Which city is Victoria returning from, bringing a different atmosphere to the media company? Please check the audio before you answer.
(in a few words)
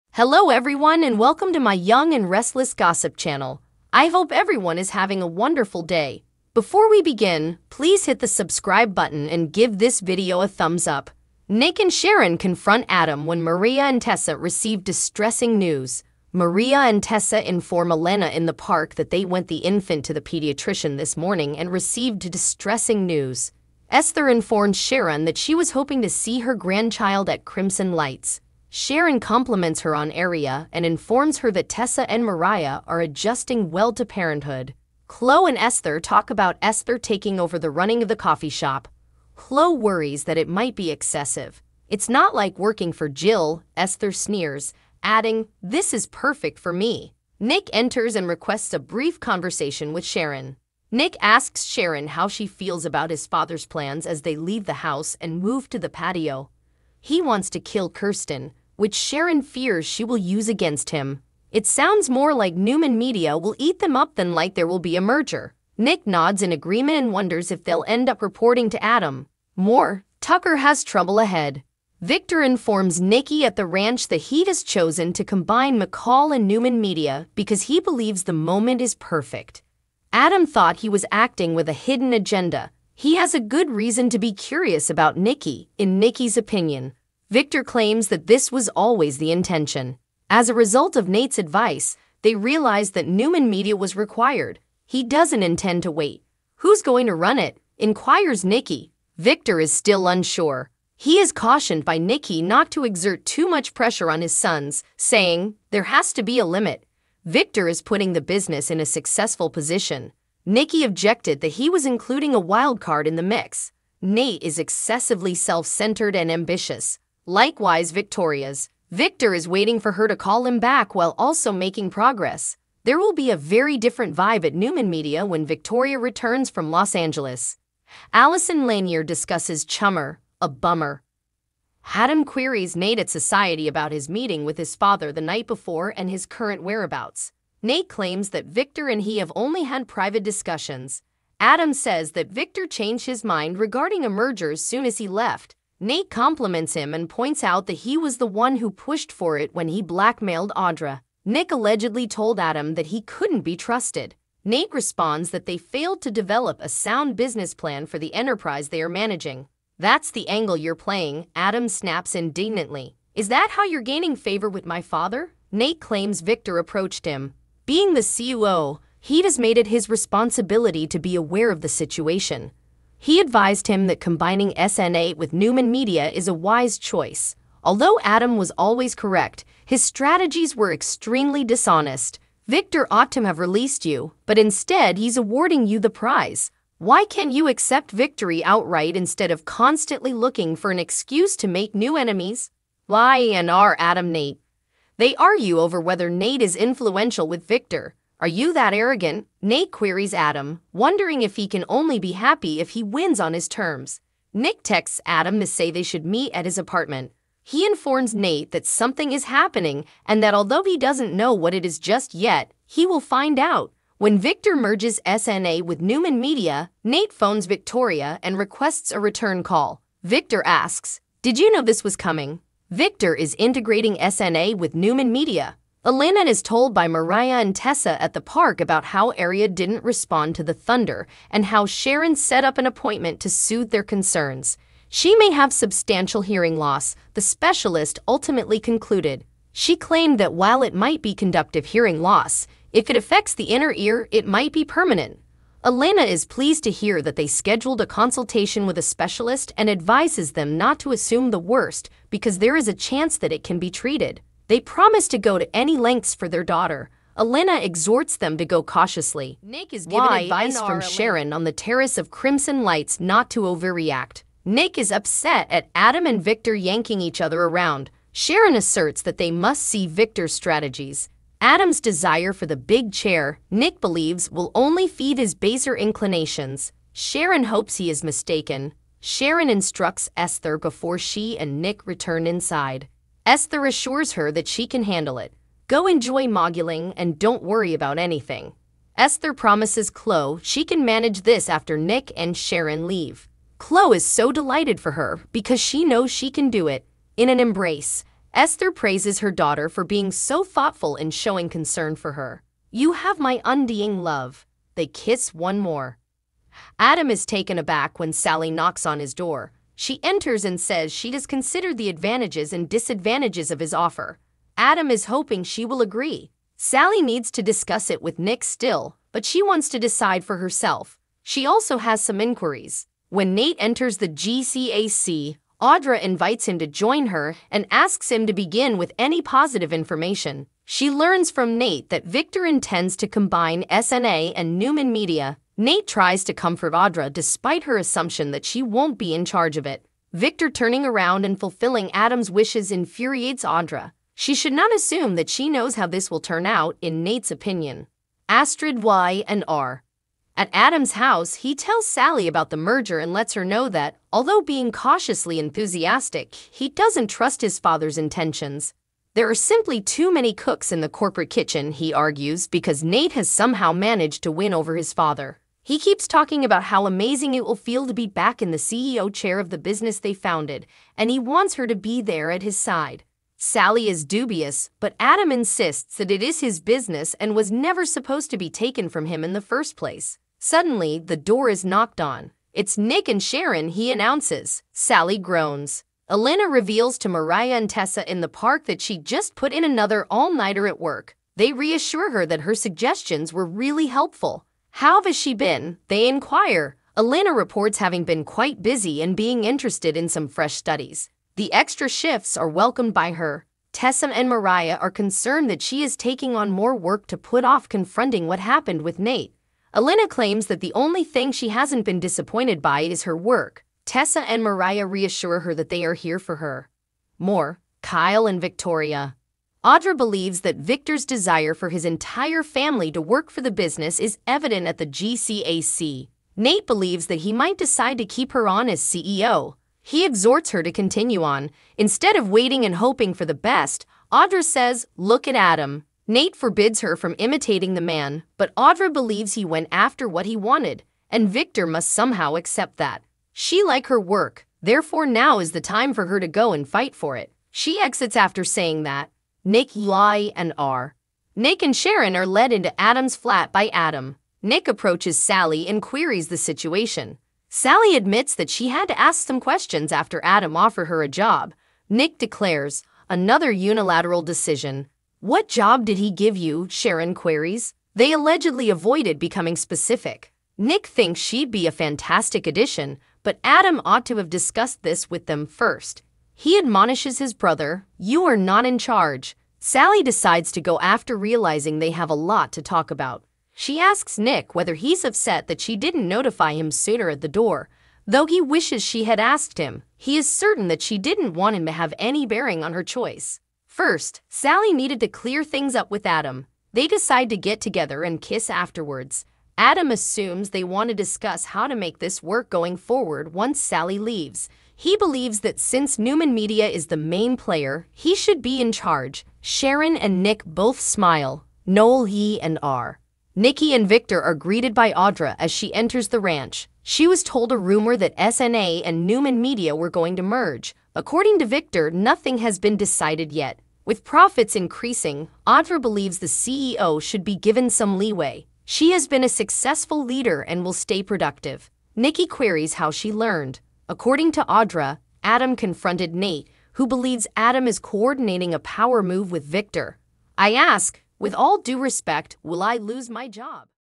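Los Angeles.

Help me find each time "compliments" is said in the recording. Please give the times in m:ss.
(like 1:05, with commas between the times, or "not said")
0:29, 2:26.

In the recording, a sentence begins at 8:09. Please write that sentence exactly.
He is certain that she didn't want him to have any bearing on her choice.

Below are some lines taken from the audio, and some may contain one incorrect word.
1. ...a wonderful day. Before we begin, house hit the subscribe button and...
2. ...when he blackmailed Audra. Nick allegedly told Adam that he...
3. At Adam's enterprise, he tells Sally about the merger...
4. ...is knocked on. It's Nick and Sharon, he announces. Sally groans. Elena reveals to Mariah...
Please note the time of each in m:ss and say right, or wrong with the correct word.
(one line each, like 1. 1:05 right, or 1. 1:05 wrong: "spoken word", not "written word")
1. 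0:05 wrong: "please", not "house"
2. 2:29 right
3. 5:50 wrong: "house", not "enterprise"
4. 6:21 right.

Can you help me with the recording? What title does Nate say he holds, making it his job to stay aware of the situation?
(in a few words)
COO.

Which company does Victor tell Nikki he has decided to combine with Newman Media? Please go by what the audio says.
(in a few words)
McCall.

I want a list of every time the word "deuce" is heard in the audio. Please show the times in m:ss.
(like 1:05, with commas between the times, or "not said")
not said.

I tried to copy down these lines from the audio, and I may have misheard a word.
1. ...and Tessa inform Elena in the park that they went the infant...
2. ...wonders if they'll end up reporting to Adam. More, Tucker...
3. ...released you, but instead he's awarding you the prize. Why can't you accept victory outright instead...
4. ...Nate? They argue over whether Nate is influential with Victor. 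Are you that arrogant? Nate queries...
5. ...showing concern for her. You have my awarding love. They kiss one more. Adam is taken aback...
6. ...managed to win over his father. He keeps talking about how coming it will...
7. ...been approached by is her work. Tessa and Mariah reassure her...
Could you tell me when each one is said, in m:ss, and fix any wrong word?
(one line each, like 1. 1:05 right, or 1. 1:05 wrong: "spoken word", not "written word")
1. 0:16 right
2. 1:07 right
3. 3:03 right
4. 3:14 right
5. 5:01 wrong: "undying", not "awarding"
6. 6:03 wrong: "amazing", not "coming"
7. 6:51 wrong: "disappointed", not "approached".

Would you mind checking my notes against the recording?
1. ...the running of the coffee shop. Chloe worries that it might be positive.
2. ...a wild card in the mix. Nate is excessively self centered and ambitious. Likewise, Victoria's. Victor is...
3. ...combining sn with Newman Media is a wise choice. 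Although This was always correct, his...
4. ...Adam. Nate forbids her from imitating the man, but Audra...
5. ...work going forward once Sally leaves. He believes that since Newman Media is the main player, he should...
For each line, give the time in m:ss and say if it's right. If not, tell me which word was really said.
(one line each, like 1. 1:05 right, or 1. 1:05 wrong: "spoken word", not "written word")
1. 0:37 wrong: "excessive", not "positive"
2. 1:52 right
3. 2:53 wrong: "Adam", not "This"
4. 7:15 right
5. 8:22 right.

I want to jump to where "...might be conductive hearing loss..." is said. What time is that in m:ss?
4:00.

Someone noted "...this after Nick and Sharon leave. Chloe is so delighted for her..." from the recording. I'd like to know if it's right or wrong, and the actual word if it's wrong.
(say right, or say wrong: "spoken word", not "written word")
right.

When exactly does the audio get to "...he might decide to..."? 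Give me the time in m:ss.
7:07.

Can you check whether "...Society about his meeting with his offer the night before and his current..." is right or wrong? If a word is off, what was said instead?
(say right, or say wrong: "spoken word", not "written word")
wrong: "father", not "offer".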